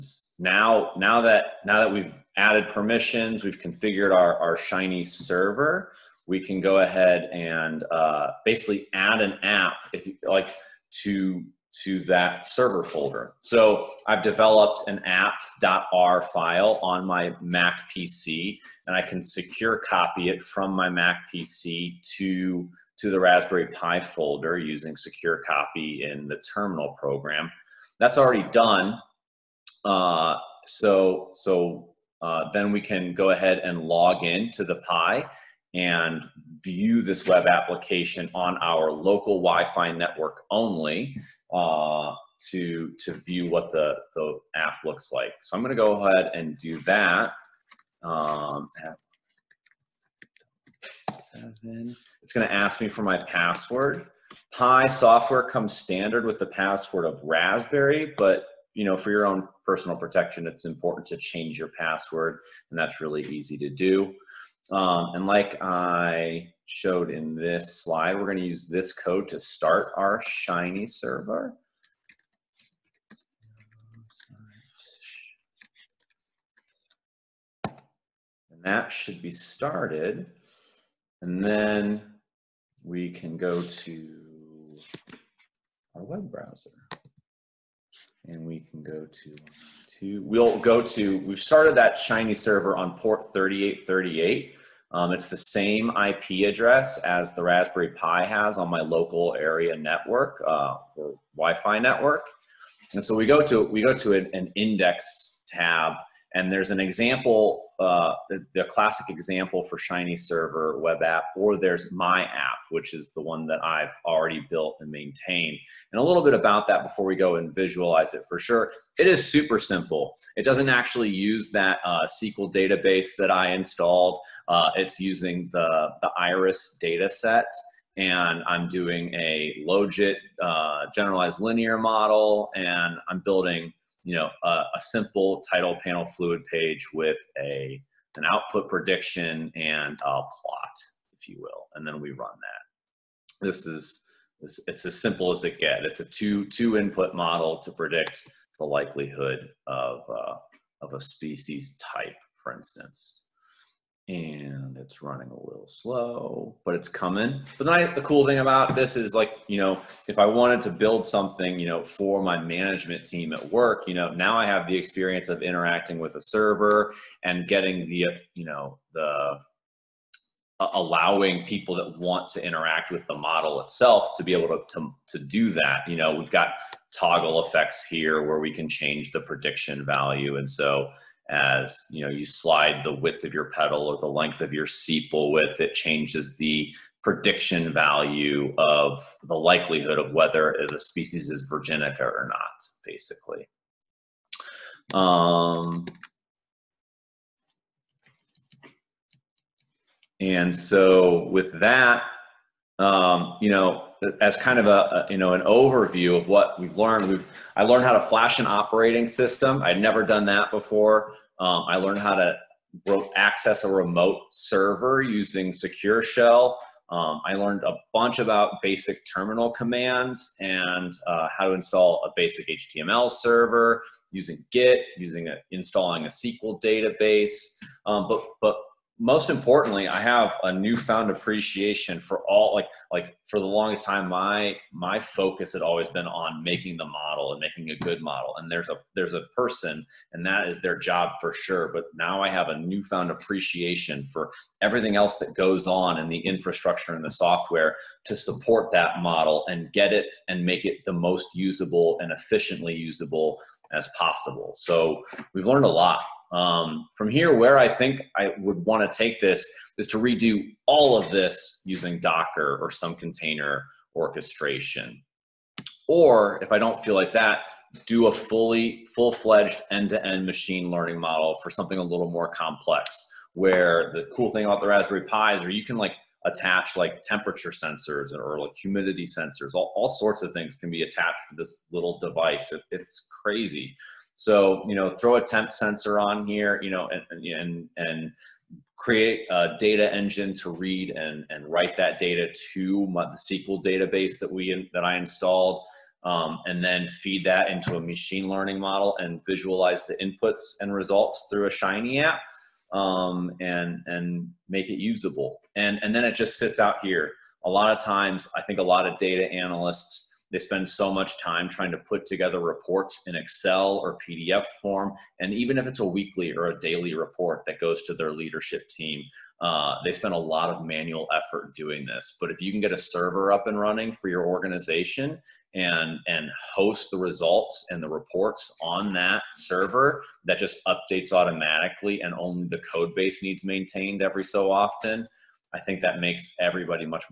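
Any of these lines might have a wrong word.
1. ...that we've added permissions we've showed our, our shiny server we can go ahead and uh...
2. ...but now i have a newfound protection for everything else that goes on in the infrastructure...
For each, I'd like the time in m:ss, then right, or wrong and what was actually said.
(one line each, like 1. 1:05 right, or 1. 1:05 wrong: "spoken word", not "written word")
1. 0:01 wrong: "configured", not "showed"
2. 4:01 wrong: "appreciation", not "protection".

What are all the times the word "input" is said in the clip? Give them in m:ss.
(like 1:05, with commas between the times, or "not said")
2:26, 4:59.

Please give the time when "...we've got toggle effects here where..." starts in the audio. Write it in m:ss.
2:56.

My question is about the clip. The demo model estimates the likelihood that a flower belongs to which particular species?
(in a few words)
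virginica.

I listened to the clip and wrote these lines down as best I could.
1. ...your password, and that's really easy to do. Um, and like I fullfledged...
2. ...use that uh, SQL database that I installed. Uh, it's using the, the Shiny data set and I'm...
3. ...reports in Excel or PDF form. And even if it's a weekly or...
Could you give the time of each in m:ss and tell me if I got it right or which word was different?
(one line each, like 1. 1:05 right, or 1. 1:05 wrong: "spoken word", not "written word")
1. 1:01 wrong: "showed", not "fullfledged"
2. 2:01 wrong: "Iris", not "Shiny"
3. 5:12 right.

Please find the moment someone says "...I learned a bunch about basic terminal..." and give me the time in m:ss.
3:37.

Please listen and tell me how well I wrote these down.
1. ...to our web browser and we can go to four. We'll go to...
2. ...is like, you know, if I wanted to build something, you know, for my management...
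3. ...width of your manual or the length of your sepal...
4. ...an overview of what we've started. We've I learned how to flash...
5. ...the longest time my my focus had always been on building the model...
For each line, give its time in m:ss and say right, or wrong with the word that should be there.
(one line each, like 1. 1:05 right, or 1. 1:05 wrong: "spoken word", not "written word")
1. 1:23 wrong: "two", not "four"
2. 2:38 right
3. 3:02 wrong: "petal", not "manual"
4. 3:25 wrong: "learned", not "started"
5. 3:53 wrong: "making", not "building".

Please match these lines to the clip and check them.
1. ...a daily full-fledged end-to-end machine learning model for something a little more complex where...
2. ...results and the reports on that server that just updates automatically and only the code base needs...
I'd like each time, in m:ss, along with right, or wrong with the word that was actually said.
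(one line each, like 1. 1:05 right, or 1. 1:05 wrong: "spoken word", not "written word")
1. 4:28 wrong: "fully", not "daily"
2. 5:26 right.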